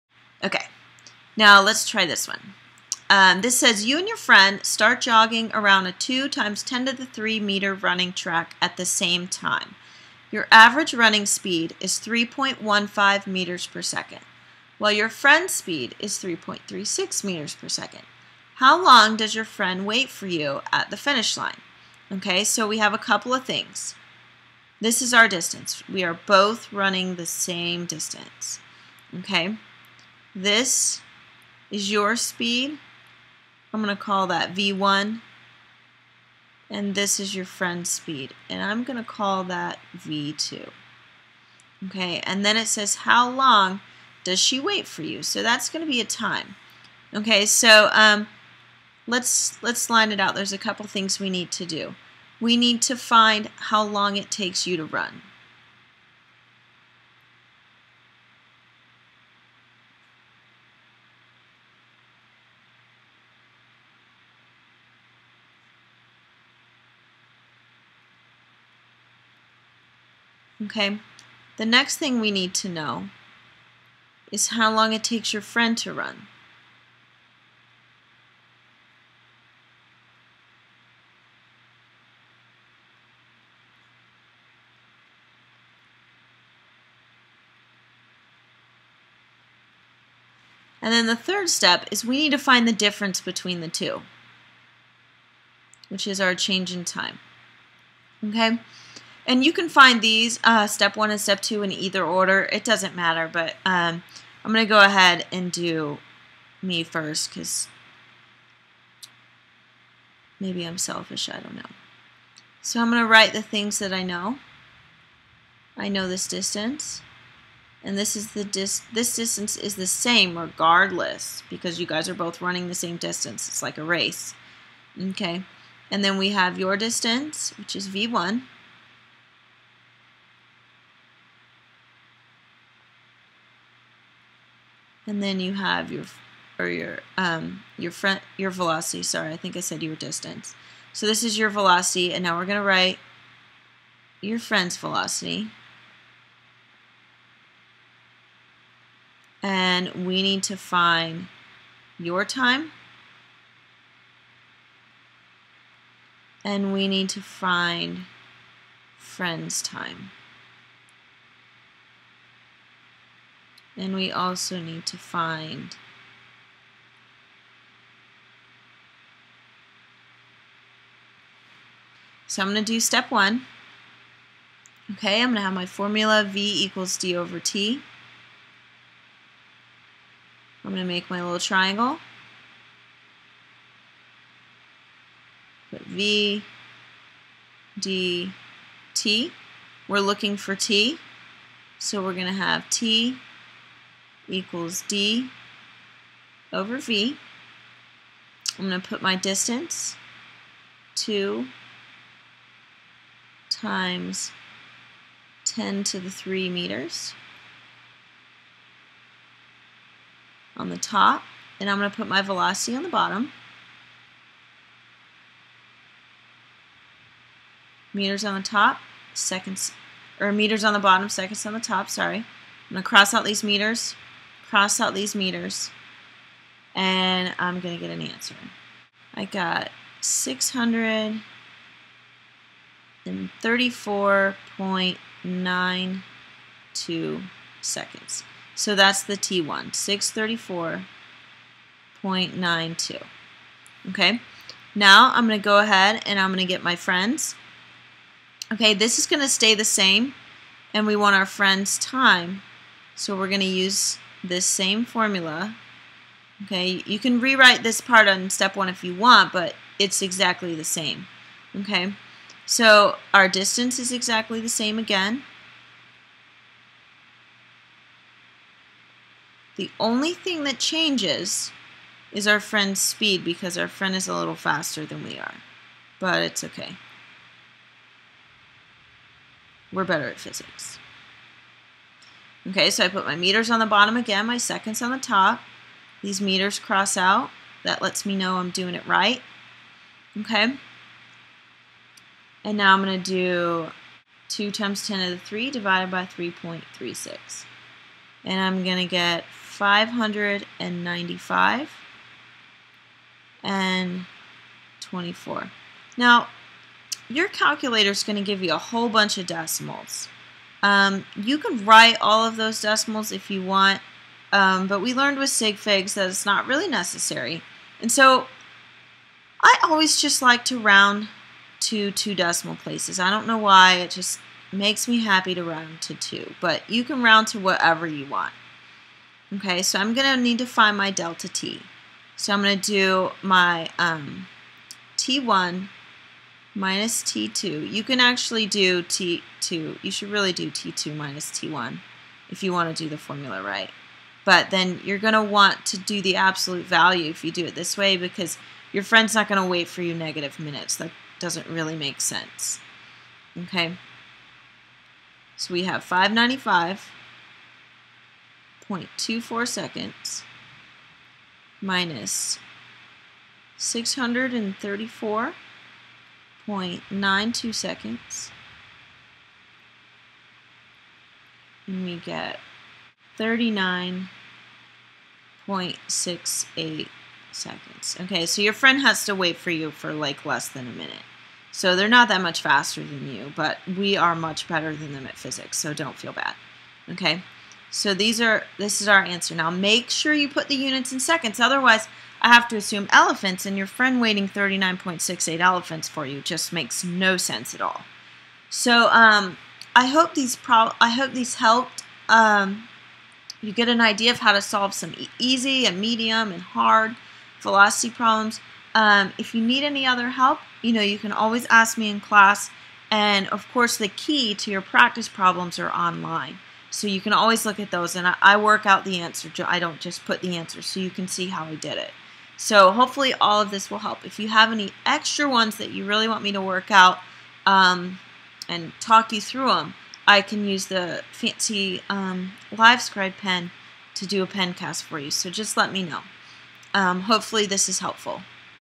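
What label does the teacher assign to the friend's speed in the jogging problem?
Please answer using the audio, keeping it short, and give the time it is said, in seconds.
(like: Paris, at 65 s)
V2, at 39 s.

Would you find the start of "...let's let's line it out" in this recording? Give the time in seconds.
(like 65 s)
49 s.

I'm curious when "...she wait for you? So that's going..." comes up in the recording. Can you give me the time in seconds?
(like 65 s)
44 s.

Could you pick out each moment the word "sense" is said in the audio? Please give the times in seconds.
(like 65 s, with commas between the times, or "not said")
352 s, 397 s.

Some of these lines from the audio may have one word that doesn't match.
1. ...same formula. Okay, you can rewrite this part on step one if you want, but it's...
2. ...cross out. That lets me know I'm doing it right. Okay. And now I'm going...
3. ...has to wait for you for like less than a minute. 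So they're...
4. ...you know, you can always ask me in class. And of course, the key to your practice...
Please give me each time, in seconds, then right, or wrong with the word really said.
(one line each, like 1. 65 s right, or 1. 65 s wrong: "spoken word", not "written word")
1. 254 s right
2. 286 s right
3. 378 s right
4. 410 s right.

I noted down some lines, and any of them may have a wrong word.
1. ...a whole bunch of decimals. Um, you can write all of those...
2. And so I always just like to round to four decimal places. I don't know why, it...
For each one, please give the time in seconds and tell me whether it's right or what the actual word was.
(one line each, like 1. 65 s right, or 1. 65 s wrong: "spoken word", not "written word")
1. 308 s right
2. 317 s wrong: "two", not "four".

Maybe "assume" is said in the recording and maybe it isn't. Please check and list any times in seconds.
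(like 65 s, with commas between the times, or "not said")
392 s.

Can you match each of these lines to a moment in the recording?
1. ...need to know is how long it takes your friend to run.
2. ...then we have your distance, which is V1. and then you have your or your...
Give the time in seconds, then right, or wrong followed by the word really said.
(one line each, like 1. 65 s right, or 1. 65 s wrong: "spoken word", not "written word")
1. 72 s right
2. 126 s right.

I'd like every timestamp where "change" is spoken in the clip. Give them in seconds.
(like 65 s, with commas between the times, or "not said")
96 s, 270 s.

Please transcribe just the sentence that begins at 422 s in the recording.
So hopefully all of this will help.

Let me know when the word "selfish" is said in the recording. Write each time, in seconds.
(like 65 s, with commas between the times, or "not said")
110 s.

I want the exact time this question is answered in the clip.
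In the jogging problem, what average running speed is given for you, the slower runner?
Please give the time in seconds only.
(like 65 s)
11 s.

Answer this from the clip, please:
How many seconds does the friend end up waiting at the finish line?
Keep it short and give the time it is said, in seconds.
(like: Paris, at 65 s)
39.68 seconds, at 373 s.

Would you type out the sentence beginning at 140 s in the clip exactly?
So this is your velocity, and now we're going to write your friend's velocity.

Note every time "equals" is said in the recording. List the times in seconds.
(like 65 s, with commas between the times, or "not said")
176 s, 194 s.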